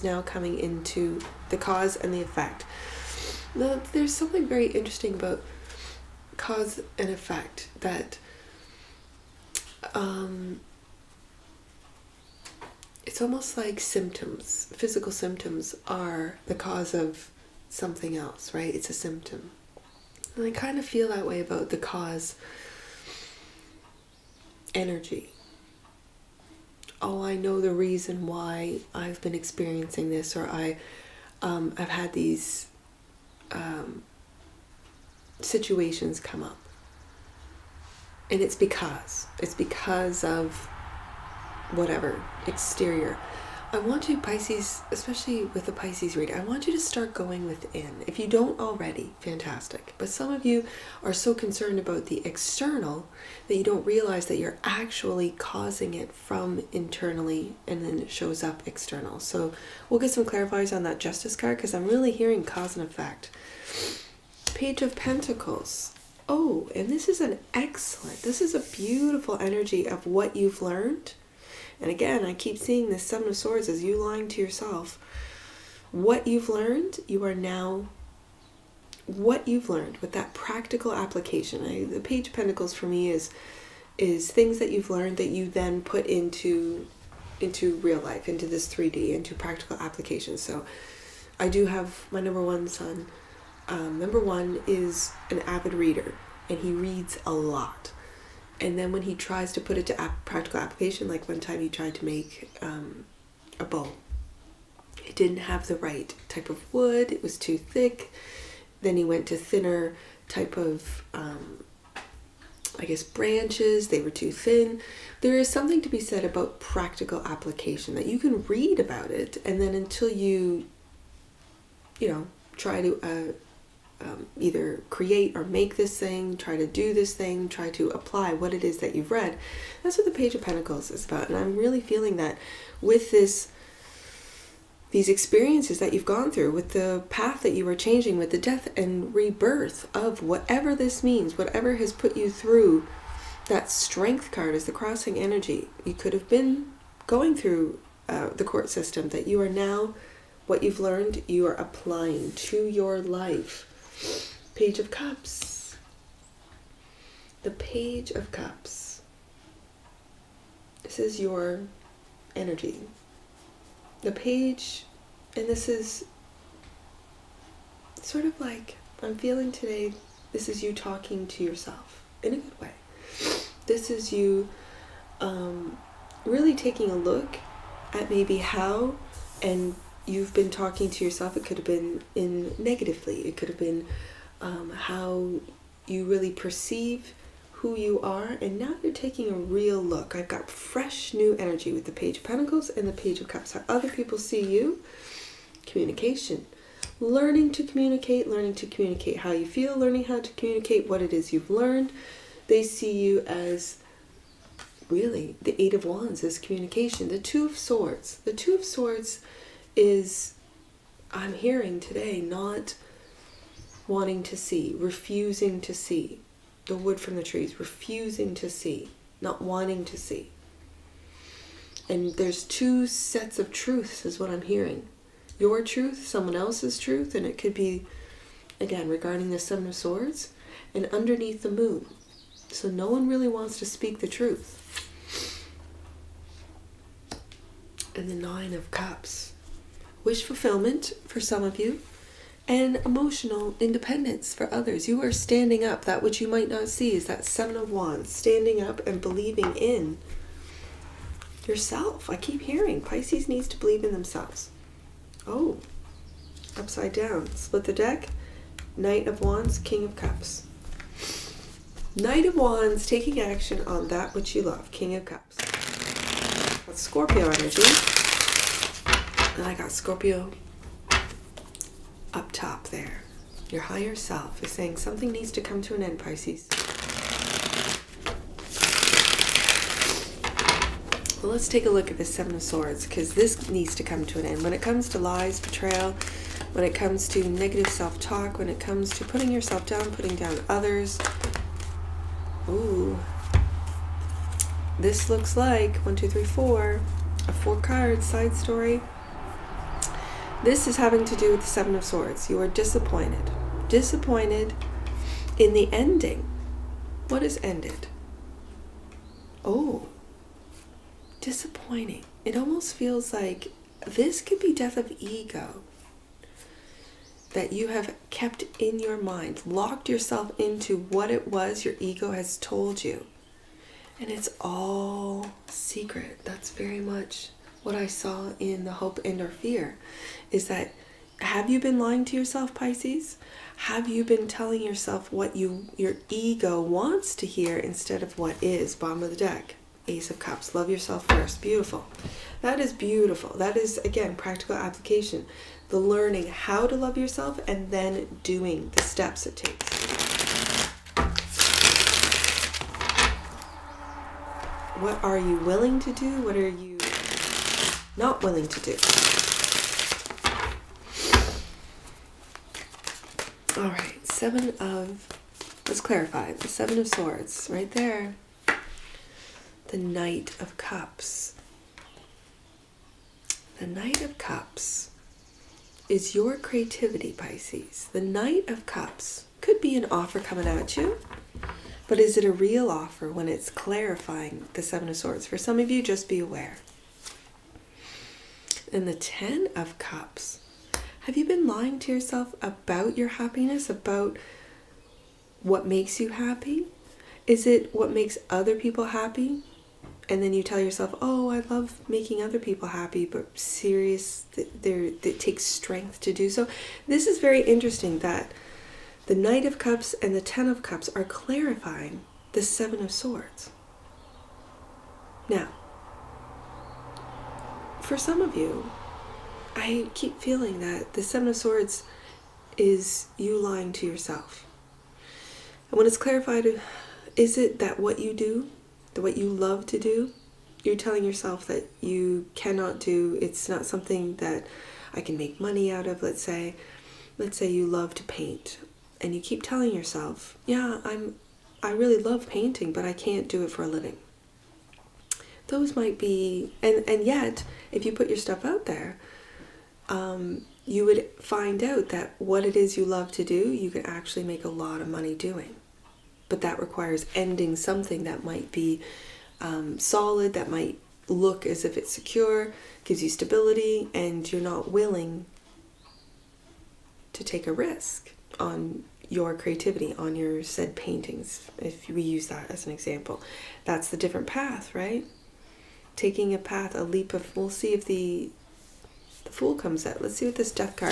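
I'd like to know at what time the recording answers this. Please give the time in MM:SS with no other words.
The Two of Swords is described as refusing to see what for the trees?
03:36.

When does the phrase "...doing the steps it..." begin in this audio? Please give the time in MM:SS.
05:48.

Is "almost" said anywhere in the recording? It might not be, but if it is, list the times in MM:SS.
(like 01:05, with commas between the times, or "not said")
00:13, 05:12.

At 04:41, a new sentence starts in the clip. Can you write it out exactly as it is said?
Well, let's take a look at the Seven of Swords because this needs to come to an end.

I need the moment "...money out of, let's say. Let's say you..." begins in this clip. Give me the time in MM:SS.
07:15.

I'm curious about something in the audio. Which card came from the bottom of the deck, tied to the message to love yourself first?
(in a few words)
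Ace of Cups.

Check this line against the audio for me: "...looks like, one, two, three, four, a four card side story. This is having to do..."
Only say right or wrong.
right.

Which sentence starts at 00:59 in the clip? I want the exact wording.
So we'll get some clarifiers on that justice card because I'm really hearing cause and effect.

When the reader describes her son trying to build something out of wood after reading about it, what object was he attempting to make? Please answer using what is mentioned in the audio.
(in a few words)
a bowl.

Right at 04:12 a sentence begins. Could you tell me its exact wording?
I keep hearing Pisces needs to believe in themselves.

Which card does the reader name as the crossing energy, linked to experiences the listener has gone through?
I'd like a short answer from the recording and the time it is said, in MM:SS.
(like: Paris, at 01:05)
strength card, at 02:23.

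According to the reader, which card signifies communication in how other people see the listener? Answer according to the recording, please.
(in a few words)
eight of wands.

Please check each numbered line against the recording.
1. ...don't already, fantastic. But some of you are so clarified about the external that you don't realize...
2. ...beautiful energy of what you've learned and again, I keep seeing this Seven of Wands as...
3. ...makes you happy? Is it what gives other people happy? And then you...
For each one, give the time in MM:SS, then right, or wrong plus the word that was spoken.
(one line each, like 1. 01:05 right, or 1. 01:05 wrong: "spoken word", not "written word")
1. 00:48 wrong: "concerned", not "clarified"
2. 01:08 wrong: "Swords", not "Wands"
3. 06:35 wrong: "makes", not "gives".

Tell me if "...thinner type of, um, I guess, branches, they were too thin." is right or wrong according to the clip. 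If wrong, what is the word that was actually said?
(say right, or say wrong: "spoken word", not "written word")
right.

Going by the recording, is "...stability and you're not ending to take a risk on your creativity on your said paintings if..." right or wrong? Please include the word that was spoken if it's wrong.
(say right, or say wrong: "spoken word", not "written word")
wrong: "willing", not "ending".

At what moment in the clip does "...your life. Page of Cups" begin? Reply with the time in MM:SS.
02:32.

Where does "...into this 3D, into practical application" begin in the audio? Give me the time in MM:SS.
01:28.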